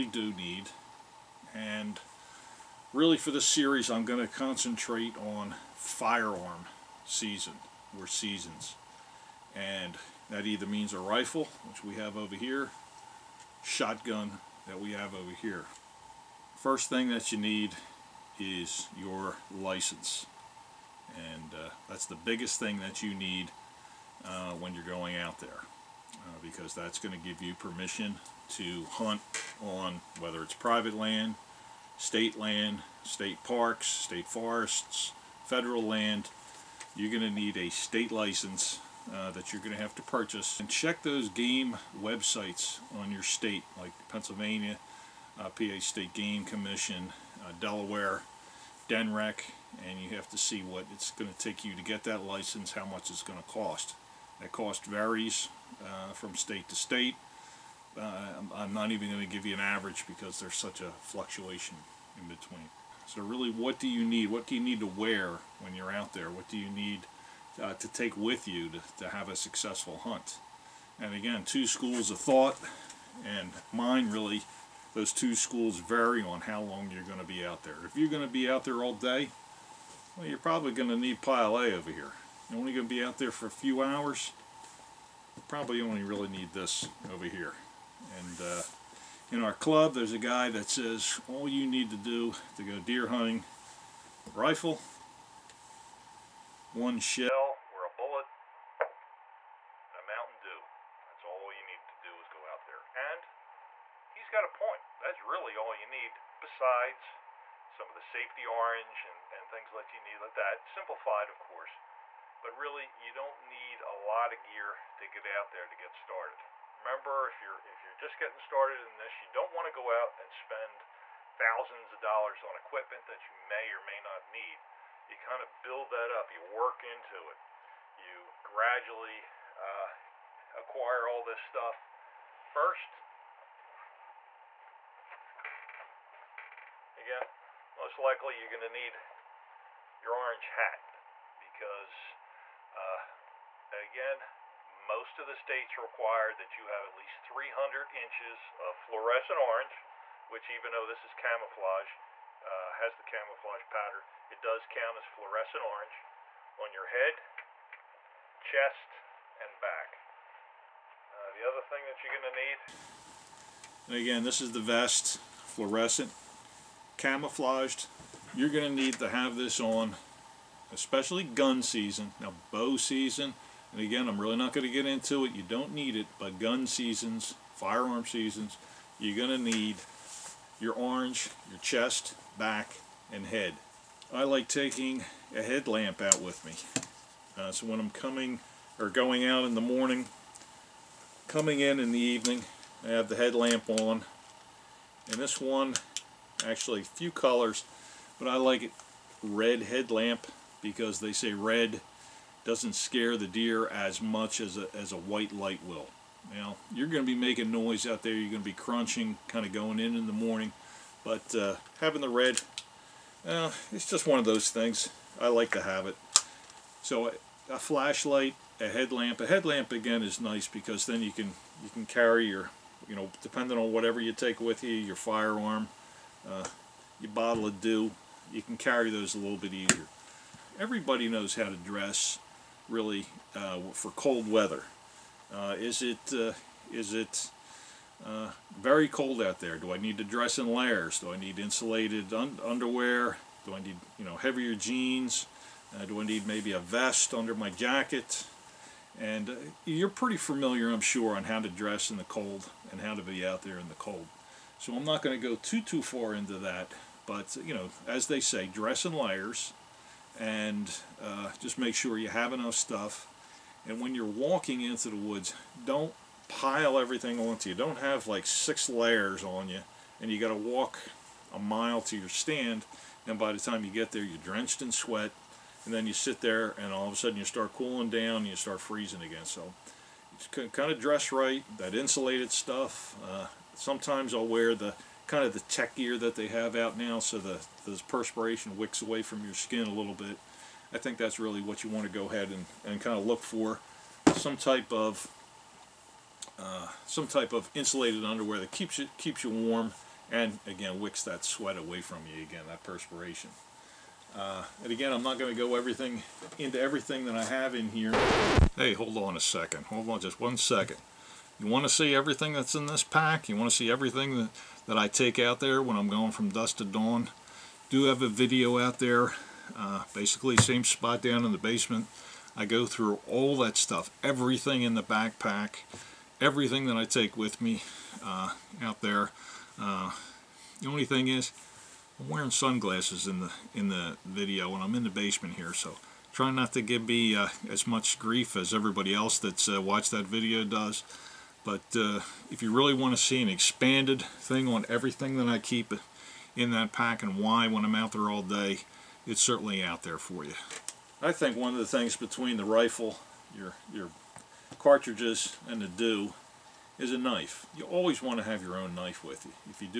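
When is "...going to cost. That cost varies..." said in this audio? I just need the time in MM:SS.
00:53.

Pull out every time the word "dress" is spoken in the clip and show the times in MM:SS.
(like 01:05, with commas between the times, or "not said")
03:51, 04:00, 04:11, 04:18, 04:40.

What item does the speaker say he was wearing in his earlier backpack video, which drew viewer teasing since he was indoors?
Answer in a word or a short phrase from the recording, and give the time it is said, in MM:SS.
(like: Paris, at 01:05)
Sunglasses, at 05:32.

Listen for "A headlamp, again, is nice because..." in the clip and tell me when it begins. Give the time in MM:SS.
03:39.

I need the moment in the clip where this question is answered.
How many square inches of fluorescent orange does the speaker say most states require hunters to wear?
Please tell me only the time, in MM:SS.
02:27.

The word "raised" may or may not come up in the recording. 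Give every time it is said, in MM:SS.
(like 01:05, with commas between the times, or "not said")
not said.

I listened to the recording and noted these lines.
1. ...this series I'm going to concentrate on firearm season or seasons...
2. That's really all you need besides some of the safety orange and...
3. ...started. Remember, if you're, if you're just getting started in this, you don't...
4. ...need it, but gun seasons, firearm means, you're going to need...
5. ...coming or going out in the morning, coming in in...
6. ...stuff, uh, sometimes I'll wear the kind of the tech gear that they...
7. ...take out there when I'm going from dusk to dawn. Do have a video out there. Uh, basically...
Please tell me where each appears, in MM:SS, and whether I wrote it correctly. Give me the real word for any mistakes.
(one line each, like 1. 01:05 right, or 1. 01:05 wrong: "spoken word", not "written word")
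1. 00:03 right
2. 01:44 right
3. 01:55 right
4. 02:55 wrong: "seasons", not "means"
5. 03:07 right
6. 04:42 right
7. 05:14 right.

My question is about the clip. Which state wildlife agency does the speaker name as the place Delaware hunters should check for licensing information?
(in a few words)
DNREC.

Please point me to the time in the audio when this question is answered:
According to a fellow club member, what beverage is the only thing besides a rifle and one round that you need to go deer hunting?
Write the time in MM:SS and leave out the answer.
01:40.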